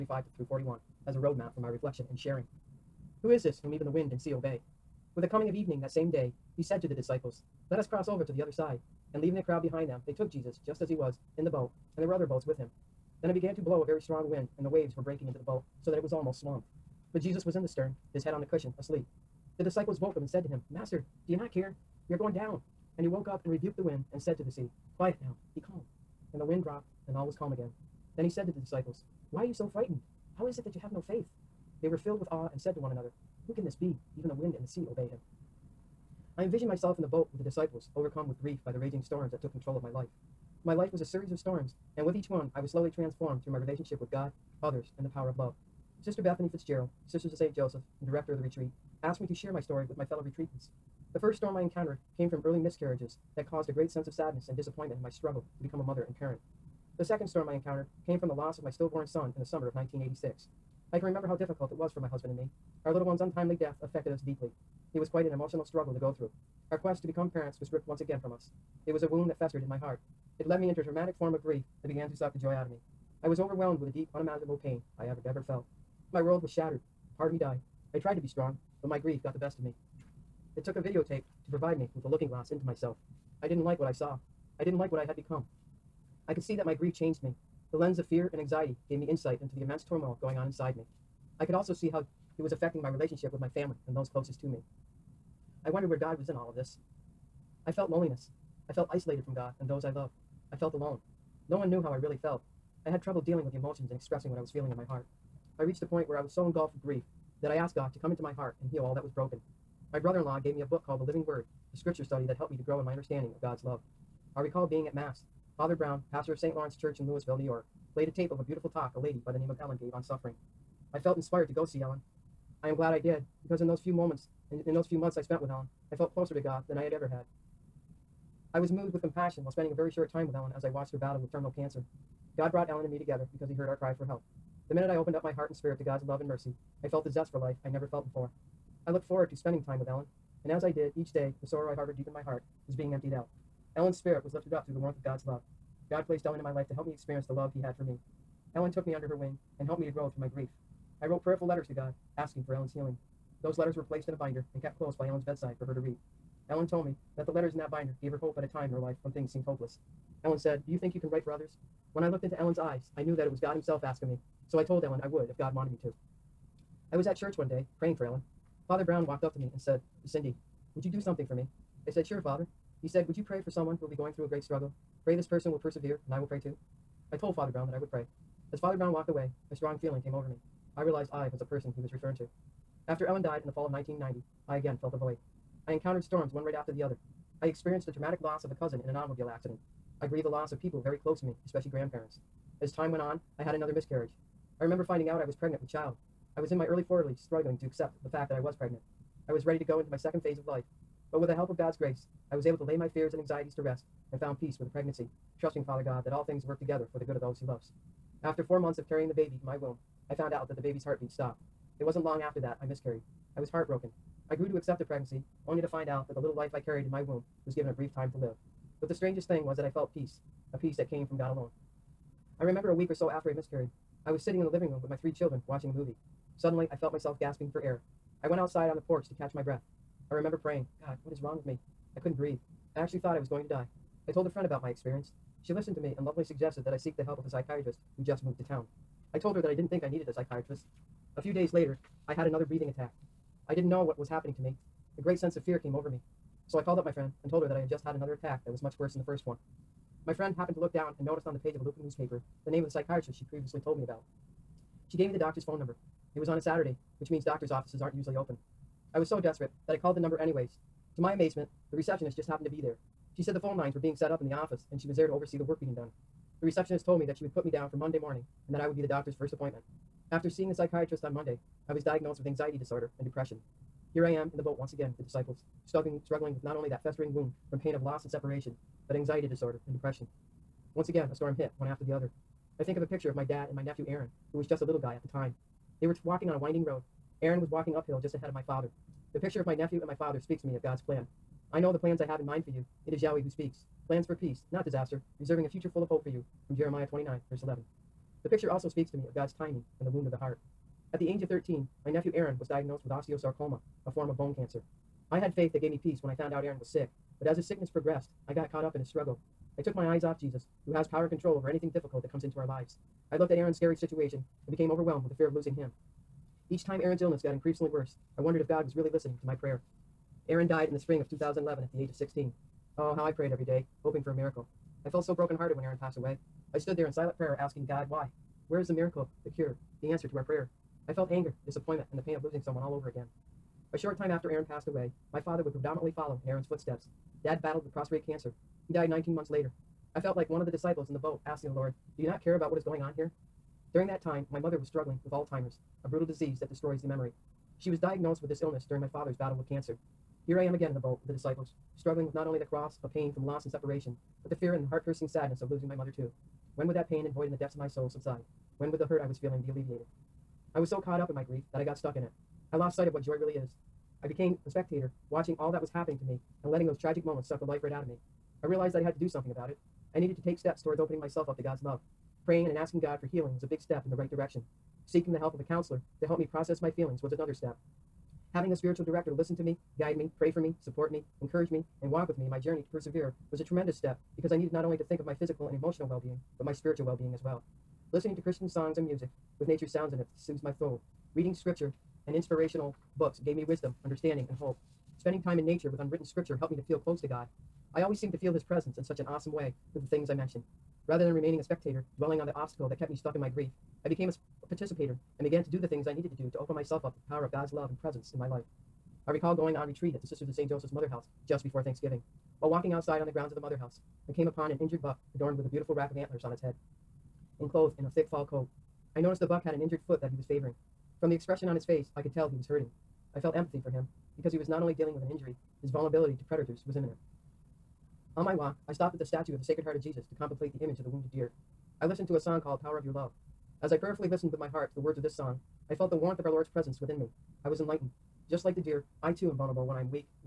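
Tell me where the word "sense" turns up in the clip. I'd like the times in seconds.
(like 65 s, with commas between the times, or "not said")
53 s, 245 s.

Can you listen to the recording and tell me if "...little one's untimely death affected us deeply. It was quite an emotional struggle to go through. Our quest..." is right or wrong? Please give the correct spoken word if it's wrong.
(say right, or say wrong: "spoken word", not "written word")
right.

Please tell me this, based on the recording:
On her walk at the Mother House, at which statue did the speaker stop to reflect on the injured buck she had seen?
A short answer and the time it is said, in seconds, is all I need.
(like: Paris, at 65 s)
Sacred Heart of Jesus, at 429 s.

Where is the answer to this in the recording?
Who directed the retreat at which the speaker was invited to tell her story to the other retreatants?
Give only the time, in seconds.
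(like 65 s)
46 s.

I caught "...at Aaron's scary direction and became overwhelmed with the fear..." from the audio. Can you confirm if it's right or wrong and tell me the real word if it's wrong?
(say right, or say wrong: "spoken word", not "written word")
wrong: "situation", not "direction".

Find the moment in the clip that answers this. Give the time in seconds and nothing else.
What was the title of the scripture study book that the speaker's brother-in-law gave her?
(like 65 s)
110 s.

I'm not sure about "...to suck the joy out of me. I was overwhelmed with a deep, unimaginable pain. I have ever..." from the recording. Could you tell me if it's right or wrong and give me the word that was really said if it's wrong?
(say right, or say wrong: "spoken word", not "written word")
right.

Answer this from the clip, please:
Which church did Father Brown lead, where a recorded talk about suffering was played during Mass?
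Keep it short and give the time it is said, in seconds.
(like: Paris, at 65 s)
St. Lawrence Church, at 116 s.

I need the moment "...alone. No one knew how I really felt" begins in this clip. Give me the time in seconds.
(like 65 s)
100 s.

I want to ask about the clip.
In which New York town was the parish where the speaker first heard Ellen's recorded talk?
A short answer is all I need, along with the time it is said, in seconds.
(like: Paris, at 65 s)
Louisville, at 117 s.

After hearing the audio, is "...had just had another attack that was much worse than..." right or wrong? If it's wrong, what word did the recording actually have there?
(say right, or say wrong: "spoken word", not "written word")
right.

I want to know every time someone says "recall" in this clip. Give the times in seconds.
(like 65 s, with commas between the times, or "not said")
114 s, 409 s.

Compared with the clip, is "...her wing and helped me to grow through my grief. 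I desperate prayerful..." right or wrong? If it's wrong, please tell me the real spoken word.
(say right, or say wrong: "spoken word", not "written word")
wrong: "wrote", not "desperate".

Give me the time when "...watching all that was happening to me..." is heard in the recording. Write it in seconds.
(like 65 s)
365 s.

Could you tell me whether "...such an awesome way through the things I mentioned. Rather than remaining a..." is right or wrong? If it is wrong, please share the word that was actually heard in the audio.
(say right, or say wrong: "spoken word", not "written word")
right.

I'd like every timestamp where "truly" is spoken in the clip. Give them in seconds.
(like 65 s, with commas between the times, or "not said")
not said.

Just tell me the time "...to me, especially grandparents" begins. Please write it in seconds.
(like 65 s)
191 s.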